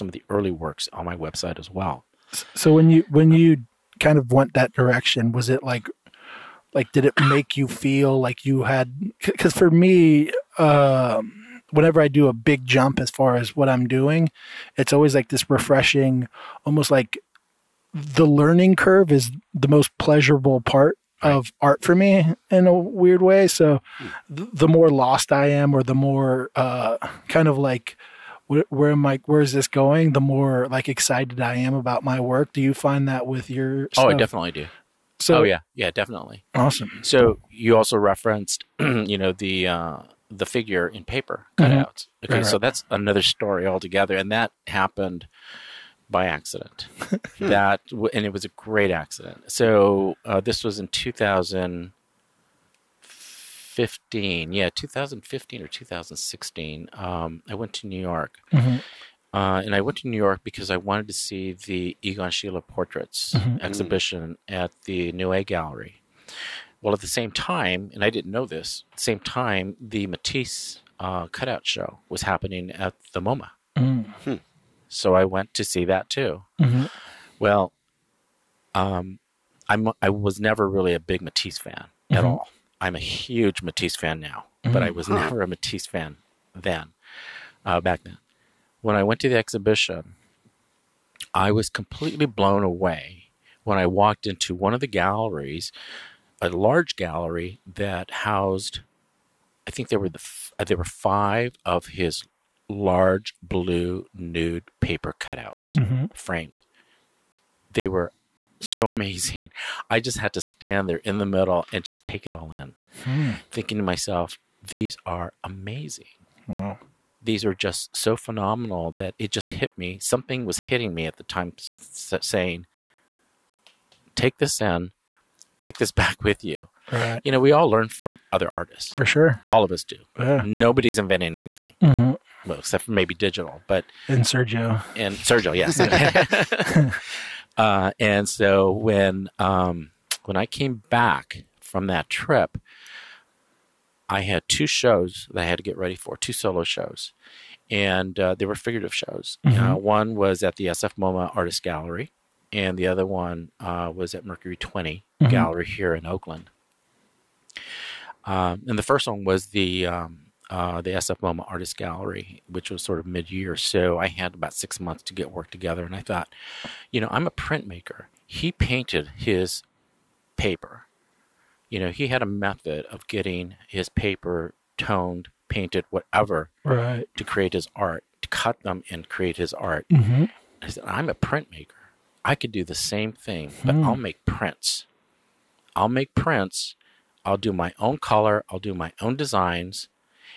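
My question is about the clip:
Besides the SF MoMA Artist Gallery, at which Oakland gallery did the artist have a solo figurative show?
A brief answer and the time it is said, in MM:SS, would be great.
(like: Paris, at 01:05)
Mercury 20, at 02:34.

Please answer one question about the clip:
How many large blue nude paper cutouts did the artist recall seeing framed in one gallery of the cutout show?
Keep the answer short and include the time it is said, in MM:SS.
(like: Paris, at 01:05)
5, at 01:40.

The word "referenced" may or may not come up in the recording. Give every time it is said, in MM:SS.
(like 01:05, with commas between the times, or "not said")
00:37.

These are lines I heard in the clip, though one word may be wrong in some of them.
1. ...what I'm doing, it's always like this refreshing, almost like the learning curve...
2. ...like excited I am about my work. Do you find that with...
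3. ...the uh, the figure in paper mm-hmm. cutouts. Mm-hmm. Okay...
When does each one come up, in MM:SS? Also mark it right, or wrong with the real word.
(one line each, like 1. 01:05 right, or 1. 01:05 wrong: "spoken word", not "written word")
1. 00:13 right
2. 00:30 right
3. 00:39 right.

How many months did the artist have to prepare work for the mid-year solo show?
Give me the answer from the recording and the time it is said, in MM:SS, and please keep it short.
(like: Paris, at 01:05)
6, at 02:44.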